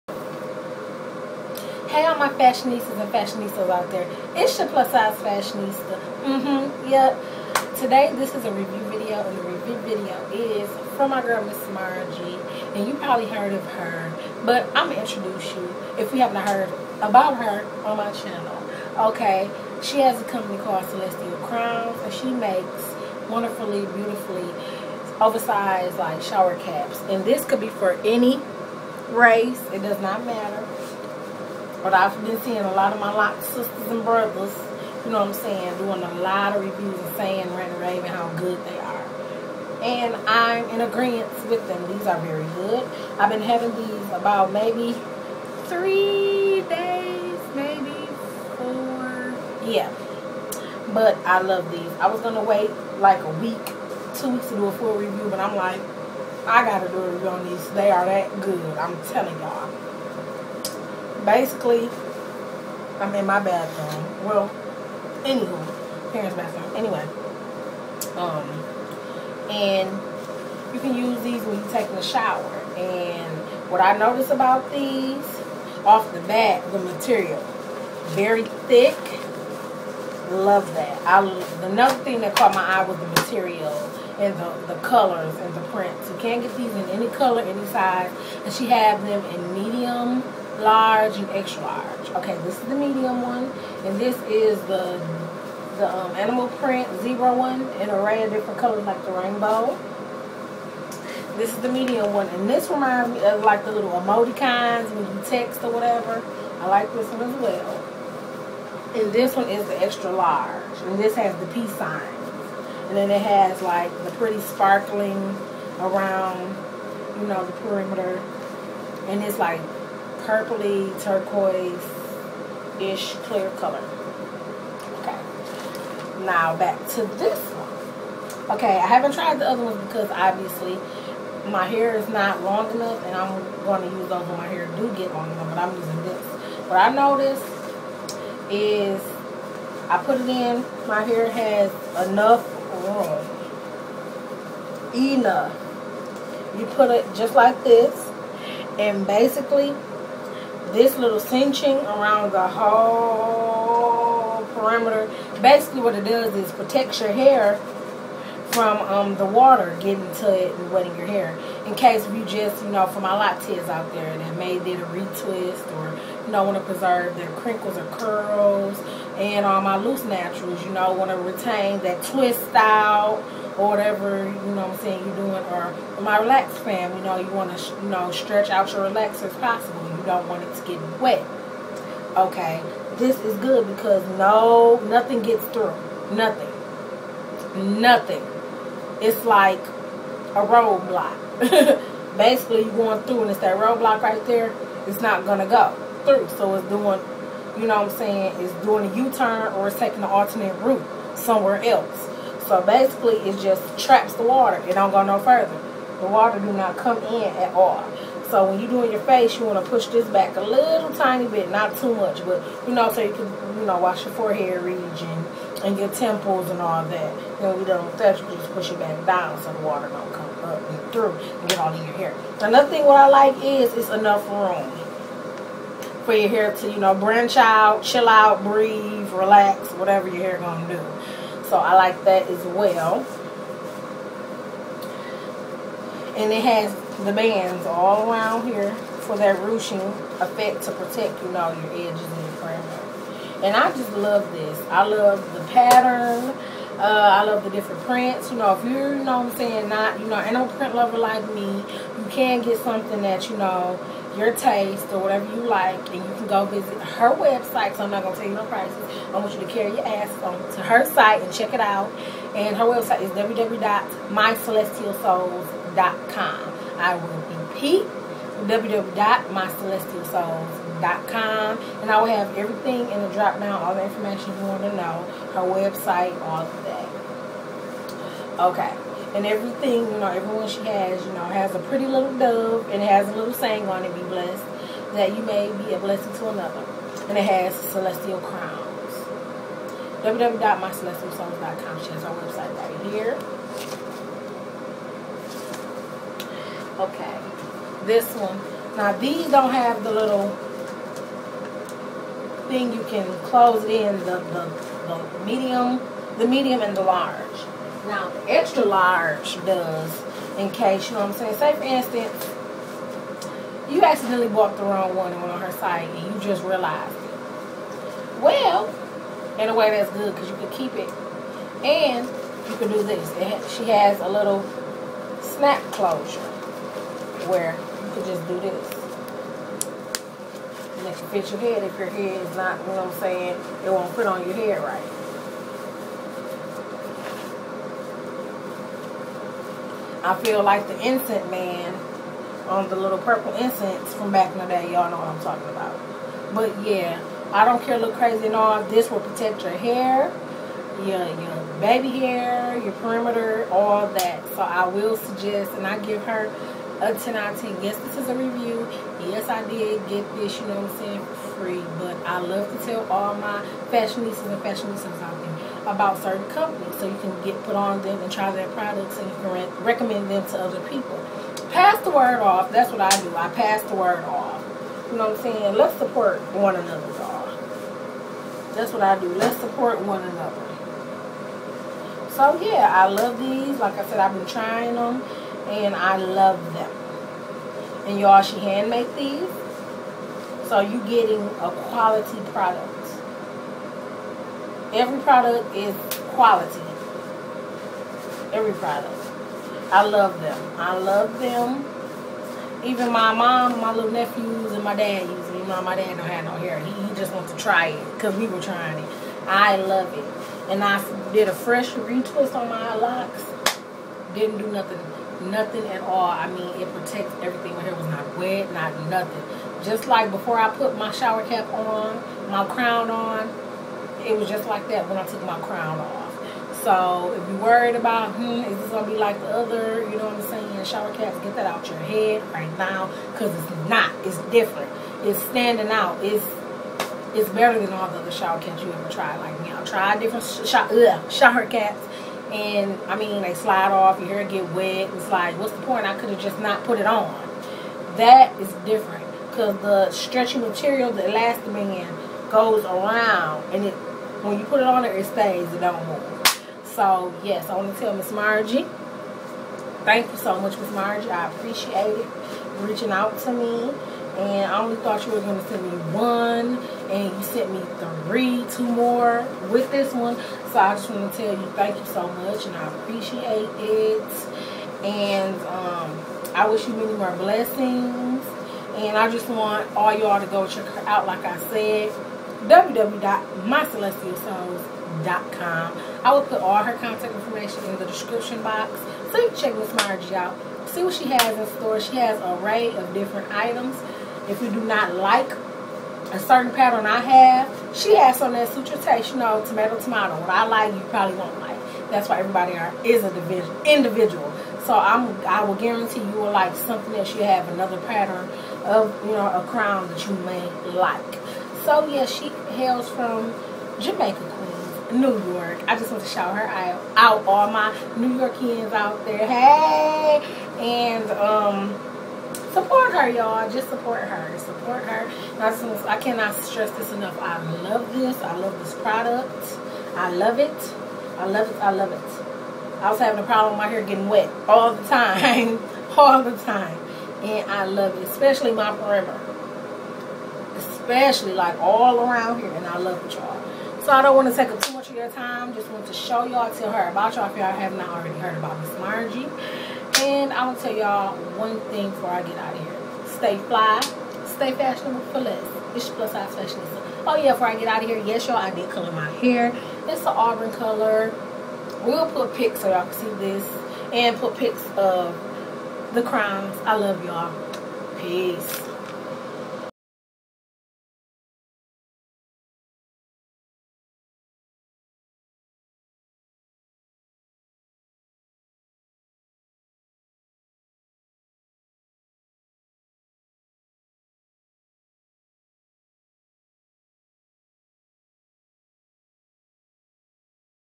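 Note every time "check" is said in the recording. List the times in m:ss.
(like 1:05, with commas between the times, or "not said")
4:21, 8:00, 8:09.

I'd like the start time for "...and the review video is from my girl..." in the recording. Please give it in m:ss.
0:09.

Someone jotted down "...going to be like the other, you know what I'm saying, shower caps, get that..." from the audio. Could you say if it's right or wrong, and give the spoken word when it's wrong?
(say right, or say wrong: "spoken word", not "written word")
right.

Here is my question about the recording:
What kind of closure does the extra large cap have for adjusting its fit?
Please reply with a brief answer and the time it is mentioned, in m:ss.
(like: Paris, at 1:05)
Snap closure, at 5:25.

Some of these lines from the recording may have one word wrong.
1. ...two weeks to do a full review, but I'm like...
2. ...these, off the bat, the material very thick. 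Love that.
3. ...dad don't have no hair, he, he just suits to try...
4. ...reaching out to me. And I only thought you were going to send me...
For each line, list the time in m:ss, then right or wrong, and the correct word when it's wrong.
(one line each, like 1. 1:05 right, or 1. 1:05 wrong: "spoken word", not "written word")
1. 0:54 right
2. 1:14 right
3. 6:45 wrong: "wants", not "suits"
4. 7:42 right.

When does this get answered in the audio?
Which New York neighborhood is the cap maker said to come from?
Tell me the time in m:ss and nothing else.
8:33.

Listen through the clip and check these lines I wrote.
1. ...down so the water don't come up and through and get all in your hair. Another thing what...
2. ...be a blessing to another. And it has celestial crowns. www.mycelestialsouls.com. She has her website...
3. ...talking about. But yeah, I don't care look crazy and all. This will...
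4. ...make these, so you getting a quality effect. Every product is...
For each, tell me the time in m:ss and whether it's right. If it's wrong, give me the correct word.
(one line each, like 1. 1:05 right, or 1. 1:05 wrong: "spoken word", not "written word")
1. 3:39 right
2. 4:45 right
3. 5:45 right
4. 6:28 wrong: "product", not "effect".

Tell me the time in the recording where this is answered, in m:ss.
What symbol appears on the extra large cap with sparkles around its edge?
1:51.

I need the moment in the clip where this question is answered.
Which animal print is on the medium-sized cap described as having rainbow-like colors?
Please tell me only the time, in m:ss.
1:37.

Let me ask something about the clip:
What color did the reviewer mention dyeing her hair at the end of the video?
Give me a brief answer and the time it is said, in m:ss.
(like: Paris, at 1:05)
Auburn, at 9:20.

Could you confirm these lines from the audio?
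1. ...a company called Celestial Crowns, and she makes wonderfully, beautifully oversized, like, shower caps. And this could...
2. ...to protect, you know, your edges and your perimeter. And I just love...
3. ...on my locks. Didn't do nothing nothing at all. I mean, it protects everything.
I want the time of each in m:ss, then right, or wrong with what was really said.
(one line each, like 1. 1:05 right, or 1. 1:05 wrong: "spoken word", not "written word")
1. 0:20 right
2. 4:00 right
3. 6:52 right.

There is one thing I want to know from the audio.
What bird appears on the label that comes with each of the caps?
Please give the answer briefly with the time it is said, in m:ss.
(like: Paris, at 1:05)
Dove, at 4:42.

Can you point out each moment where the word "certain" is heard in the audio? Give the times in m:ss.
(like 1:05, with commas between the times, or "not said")
6:06, 8:16.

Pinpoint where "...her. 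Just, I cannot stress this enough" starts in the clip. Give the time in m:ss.
8:44.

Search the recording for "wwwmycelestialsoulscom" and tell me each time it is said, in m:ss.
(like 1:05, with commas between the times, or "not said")
4:23, 4:28, 4:50, 8:02.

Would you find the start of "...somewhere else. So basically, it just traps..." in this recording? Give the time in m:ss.
3:21.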